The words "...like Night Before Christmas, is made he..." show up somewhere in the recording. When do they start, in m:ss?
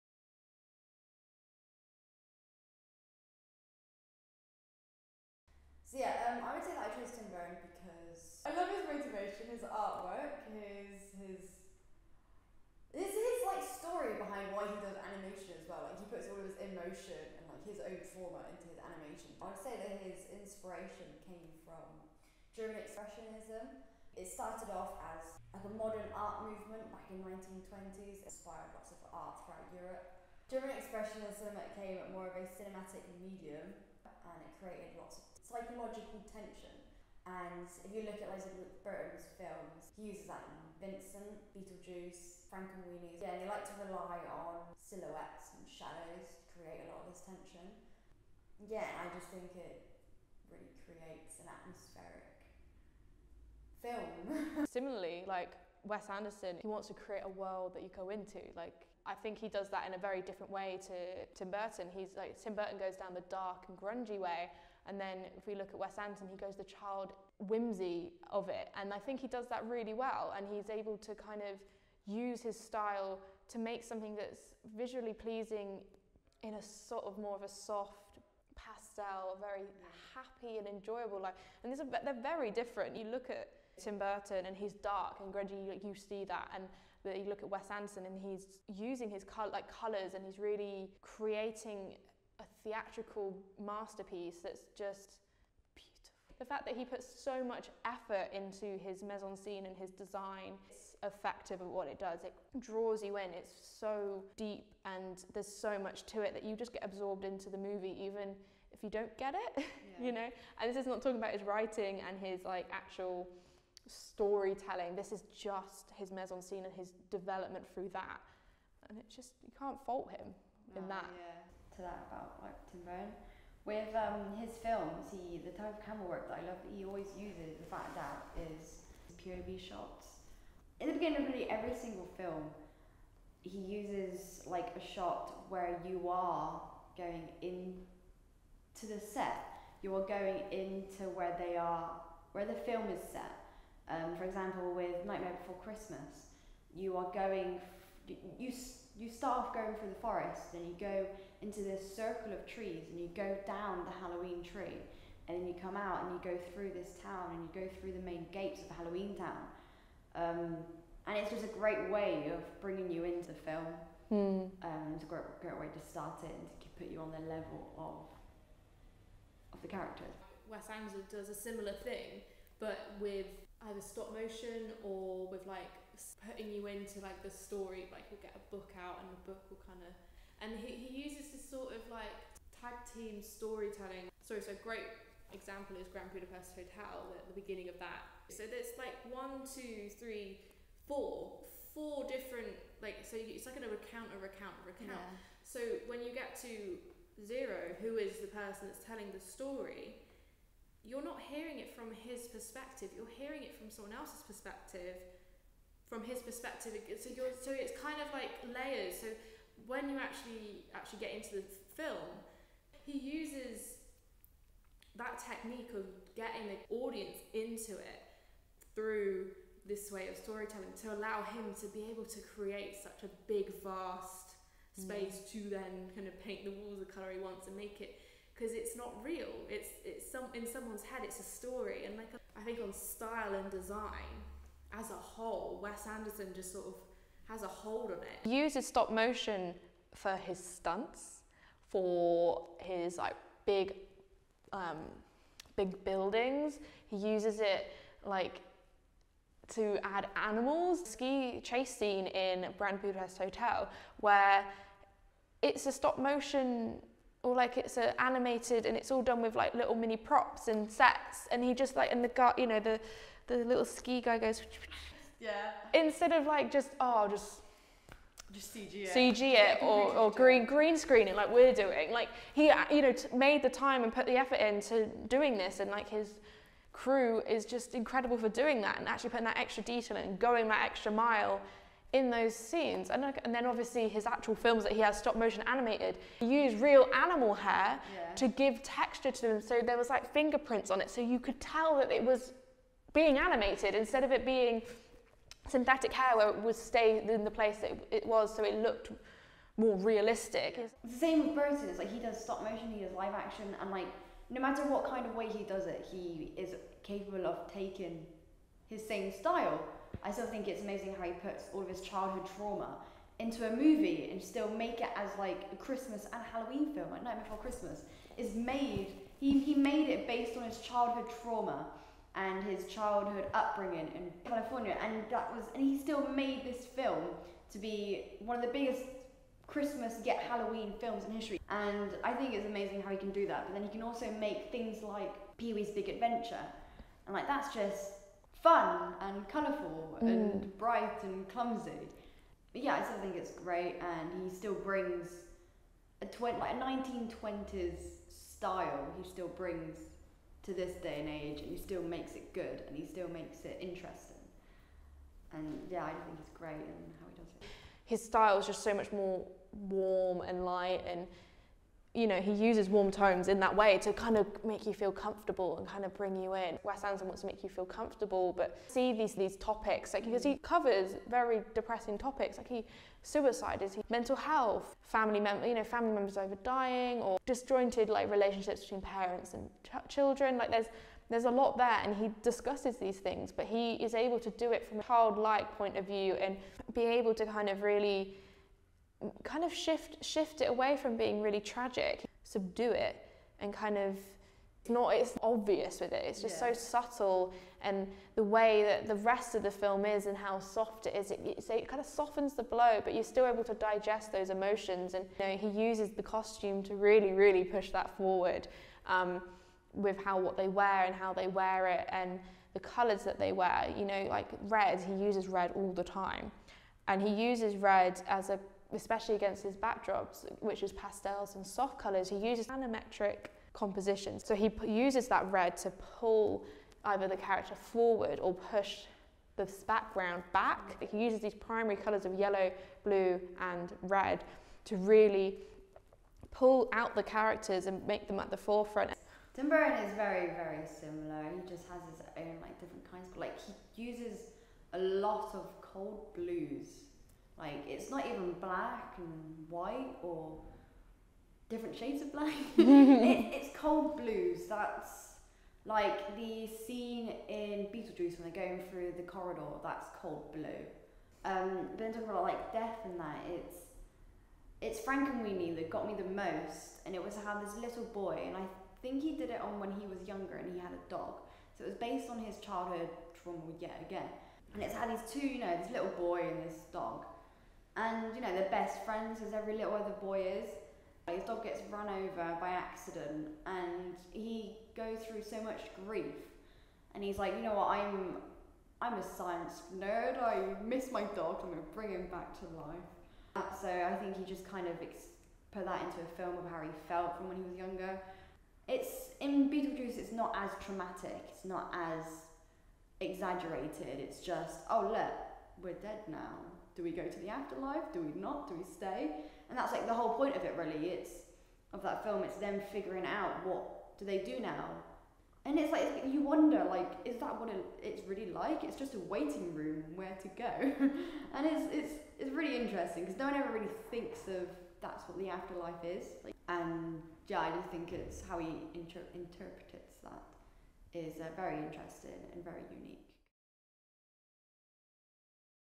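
5:16.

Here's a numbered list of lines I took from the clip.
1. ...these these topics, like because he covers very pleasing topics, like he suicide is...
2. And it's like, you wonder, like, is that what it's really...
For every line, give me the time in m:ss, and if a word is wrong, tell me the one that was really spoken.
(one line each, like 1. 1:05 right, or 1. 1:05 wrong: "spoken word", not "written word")
1. 6:08 wrong: "depressing", not "pleasing"
2. 8:35 right.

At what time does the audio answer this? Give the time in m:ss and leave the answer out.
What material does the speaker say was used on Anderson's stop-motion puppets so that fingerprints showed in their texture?
4:46.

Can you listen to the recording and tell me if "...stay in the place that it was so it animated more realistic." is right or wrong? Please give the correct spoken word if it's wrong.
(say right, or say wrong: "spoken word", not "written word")
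wrong: "looked", not "animated".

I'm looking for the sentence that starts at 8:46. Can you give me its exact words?
Like, and yeah, I just think it's how he inter- interprets that is uh, very interesting and very unique.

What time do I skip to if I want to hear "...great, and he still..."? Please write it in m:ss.
5:43.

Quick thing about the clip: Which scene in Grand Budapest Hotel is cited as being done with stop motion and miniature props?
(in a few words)
Ski chase scene.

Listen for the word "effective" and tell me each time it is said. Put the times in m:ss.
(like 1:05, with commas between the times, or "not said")
1:41.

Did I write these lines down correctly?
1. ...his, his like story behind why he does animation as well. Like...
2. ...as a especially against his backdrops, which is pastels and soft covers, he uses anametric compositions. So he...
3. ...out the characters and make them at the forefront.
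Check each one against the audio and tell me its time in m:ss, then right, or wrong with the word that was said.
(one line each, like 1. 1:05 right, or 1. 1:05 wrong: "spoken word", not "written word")
1. 0:12 right
2. 6:58 wrong: "colours", not "covers"
3. 7:16 right.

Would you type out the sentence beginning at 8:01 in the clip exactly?
His dog gets run over by accident and he goes through so much grief.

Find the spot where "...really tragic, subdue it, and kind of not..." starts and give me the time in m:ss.
6:31.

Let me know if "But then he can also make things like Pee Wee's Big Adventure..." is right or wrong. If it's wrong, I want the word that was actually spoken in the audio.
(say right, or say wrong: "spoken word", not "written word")
right.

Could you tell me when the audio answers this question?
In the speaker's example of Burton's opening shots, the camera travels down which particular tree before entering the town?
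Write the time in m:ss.
2:33.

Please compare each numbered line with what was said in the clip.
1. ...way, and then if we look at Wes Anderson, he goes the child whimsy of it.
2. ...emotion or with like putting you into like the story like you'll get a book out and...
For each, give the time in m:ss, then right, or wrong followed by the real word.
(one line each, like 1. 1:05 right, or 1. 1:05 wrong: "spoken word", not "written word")
1. 1:04 right
2. 2:54 wrong: "motion", not "emotion".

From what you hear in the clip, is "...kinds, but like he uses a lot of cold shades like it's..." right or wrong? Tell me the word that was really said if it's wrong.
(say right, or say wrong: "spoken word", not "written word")
wrong: "blues", not "shades".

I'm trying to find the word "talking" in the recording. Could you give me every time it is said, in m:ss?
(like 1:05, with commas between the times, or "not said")
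1:51, 7:41.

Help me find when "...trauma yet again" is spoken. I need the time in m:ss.
7:53.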